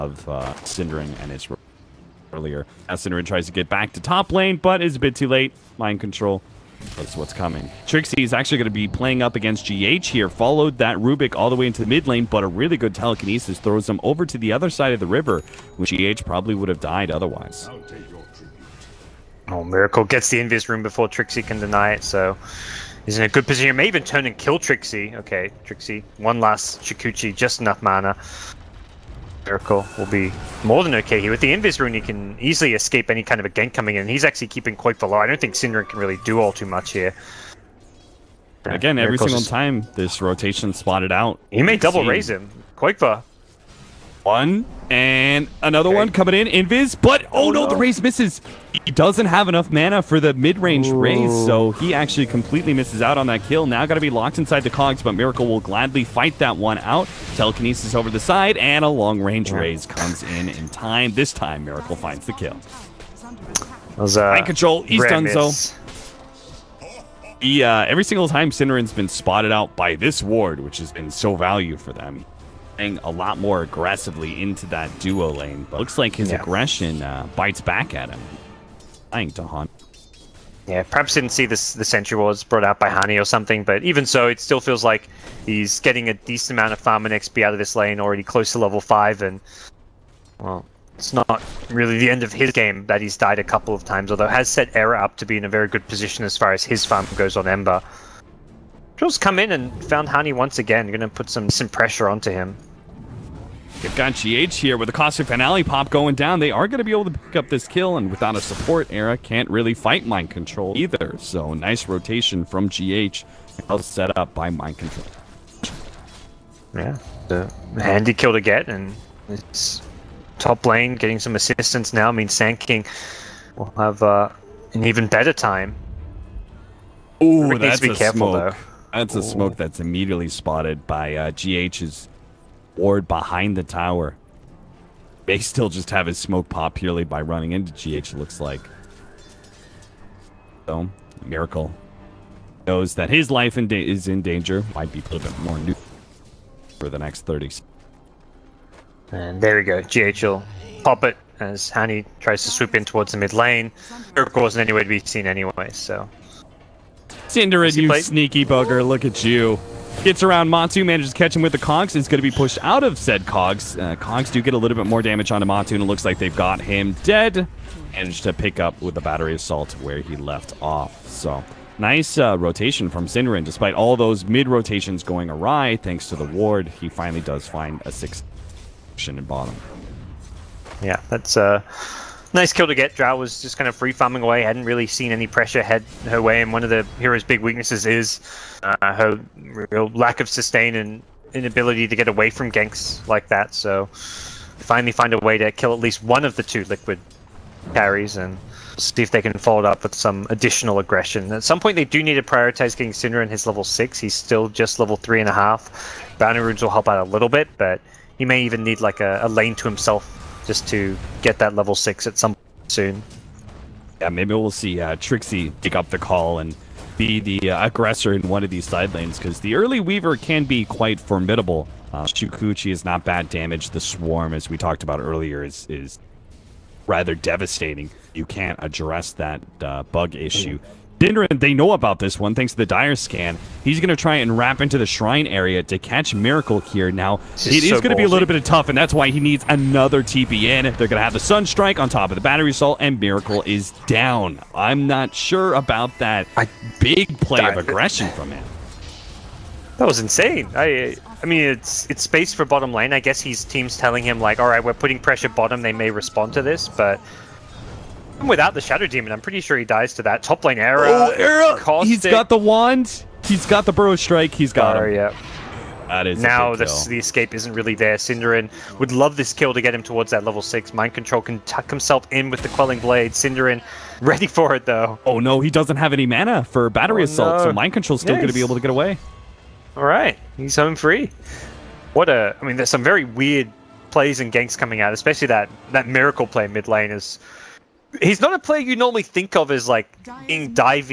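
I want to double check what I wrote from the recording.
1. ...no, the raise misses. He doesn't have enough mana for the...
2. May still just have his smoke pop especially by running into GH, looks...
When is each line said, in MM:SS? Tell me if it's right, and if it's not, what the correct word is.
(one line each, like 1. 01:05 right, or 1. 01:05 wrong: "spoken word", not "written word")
1. 00:47 right
2. 02:15 wrong: "purely", not "especially".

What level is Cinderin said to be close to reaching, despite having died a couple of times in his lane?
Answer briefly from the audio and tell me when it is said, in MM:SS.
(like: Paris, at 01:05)
5, at 01:28.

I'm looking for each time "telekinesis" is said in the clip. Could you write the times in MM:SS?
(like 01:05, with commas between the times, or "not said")
00:12, 00:57.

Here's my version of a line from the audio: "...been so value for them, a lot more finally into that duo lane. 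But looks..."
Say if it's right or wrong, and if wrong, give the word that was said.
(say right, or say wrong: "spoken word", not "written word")
wrong: "aggressively", not "finally".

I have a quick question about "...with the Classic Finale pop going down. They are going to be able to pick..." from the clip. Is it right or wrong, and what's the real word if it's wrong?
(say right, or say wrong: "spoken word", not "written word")
right.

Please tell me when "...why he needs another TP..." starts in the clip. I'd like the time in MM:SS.
03:58.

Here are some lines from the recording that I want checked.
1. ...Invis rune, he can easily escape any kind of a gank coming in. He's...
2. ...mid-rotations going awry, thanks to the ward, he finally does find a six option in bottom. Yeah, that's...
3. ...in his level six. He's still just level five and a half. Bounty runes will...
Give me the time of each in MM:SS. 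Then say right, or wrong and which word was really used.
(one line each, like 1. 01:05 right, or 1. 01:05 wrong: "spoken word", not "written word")
1. 00:31 right
2. 02:54 right
3. 03:23 wrong: "three", not "five".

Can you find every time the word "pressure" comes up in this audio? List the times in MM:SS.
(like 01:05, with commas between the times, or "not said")
01:41, 03:05, 04:14.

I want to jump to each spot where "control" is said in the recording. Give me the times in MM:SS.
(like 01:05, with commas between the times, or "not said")
00:06, 01:04, 01:50, 01:54, 04:30, 04:37.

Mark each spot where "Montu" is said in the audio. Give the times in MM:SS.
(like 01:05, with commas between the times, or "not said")
02:40, 02:45.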